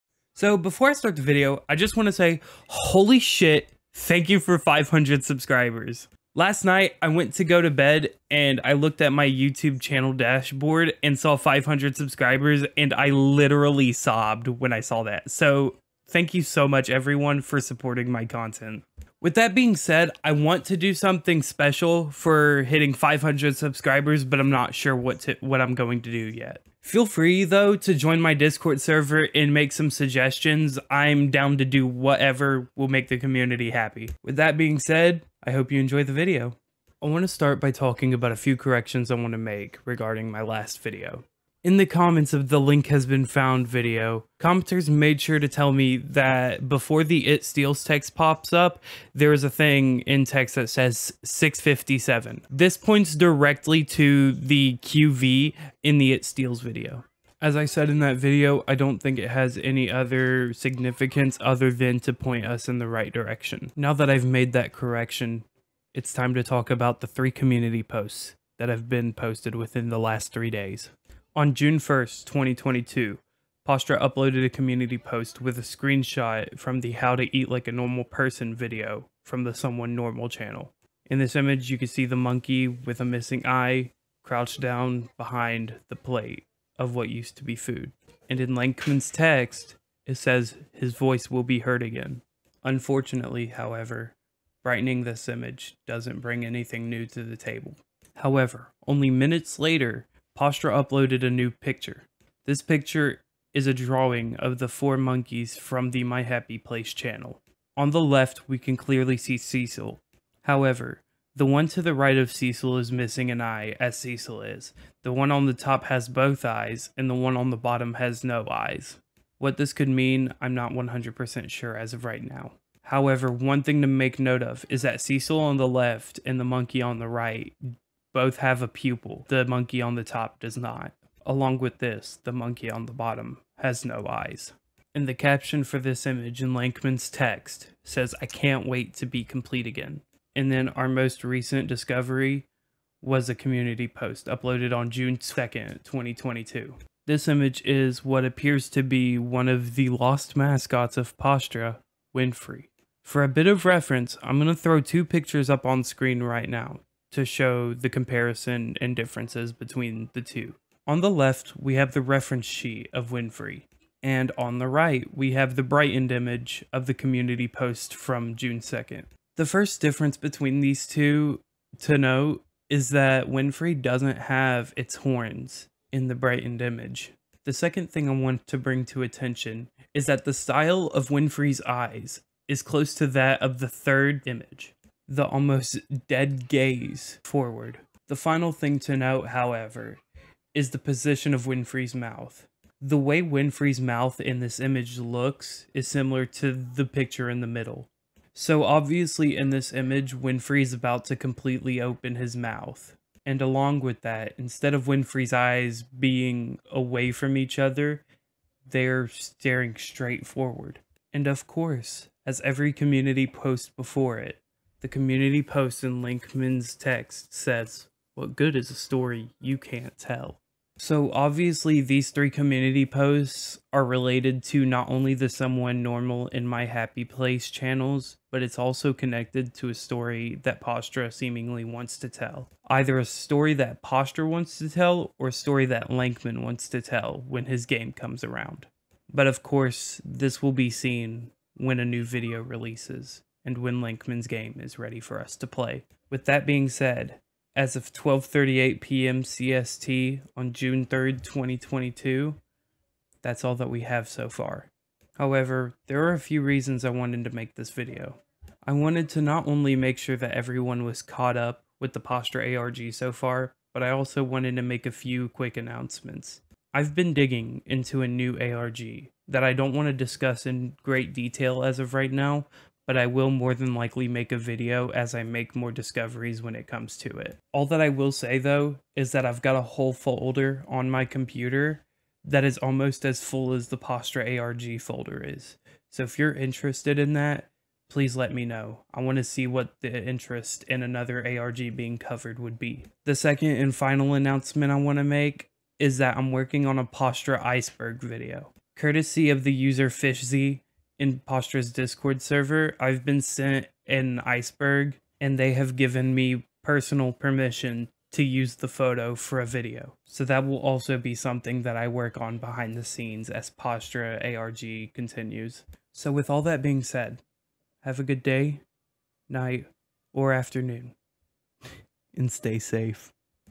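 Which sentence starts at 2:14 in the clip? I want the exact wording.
And the caption for this image in Lankman's text says, I can't wait to be complete again.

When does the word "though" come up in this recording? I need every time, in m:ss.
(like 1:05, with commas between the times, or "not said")
0:27, 4:38.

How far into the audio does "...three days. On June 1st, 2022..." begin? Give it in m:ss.
1:10.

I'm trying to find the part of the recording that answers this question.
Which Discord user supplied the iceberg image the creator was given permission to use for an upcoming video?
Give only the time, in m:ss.
4:59.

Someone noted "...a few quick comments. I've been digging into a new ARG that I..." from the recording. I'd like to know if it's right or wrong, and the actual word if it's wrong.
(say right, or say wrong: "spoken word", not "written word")
wrong: "announcements", not "comments".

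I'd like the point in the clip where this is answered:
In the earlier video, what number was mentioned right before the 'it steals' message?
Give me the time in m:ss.
0:51.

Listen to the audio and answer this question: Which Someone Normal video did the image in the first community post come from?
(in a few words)
How to Eat Like a Normal Person.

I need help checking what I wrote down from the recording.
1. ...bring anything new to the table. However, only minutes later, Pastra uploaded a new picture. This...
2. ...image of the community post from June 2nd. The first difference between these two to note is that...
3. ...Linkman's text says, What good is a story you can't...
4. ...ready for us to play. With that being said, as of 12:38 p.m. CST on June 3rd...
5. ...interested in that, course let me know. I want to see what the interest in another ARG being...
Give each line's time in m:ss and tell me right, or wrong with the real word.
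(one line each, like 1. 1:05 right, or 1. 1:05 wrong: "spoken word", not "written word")
1. 1:36 right
2. 2:46 right
3. 3:36 right
4. 4:04 right
5. 4:46 wrong: "please", not "course".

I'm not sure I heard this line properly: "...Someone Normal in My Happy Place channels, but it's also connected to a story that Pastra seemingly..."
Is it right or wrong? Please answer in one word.
right.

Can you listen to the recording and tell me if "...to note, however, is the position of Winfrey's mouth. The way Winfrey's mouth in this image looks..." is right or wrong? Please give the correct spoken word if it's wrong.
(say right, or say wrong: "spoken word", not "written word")
right.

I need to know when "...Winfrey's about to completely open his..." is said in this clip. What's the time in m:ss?
3:20.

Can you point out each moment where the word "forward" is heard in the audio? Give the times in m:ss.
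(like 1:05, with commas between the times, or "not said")
3:07, 3:30.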